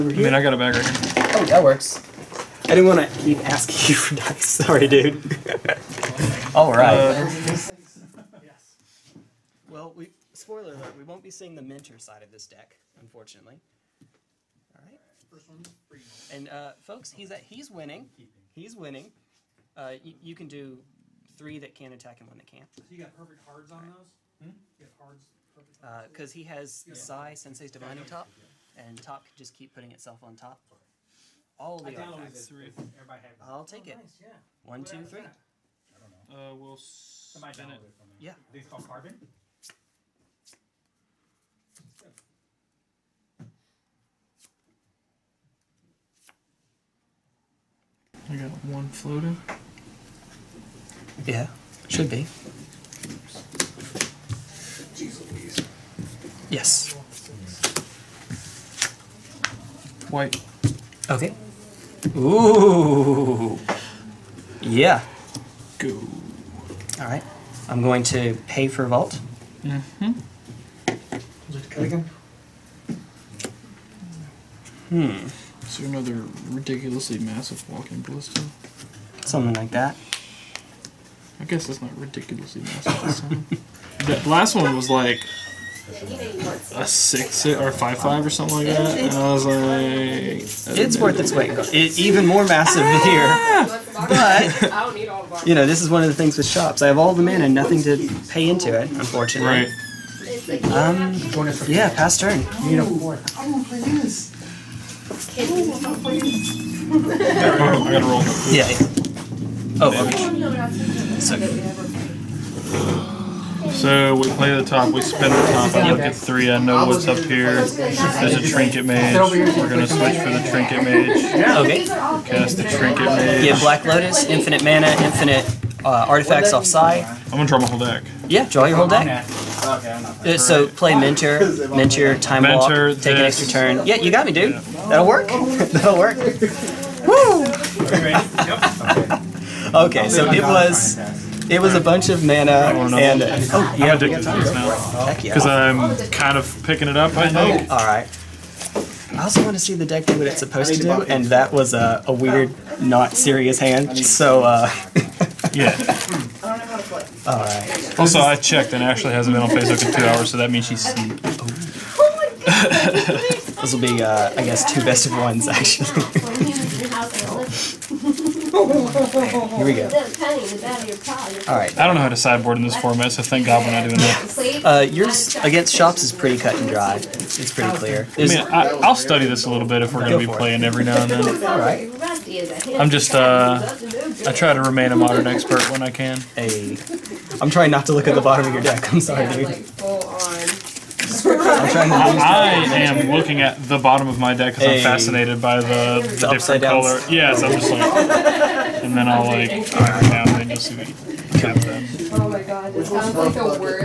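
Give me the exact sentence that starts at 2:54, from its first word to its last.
Uh, yours against shops is pretty cut and dry.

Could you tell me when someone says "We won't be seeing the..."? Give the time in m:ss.
0:10.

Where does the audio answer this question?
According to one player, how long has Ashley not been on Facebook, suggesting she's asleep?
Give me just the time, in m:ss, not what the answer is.
2:39.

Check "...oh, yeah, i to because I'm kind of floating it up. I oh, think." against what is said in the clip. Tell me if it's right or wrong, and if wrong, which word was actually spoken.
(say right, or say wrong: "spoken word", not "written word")
wrong: "picking", not "floating".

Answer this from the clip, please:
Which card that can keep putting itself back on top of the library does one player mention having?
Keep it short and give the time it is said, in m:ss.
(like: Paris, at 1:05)
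Sensei's Divining Top, at 0:27.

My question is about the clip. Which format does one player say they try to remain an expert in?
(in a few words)
Modern.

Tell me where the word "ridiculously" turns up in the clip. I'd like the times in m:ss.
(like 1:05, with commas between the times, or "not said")
1:16, 1:21.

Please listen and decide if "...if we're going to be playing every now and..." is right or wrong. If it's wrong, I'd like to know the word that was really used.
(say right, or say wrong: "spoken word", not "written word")
right.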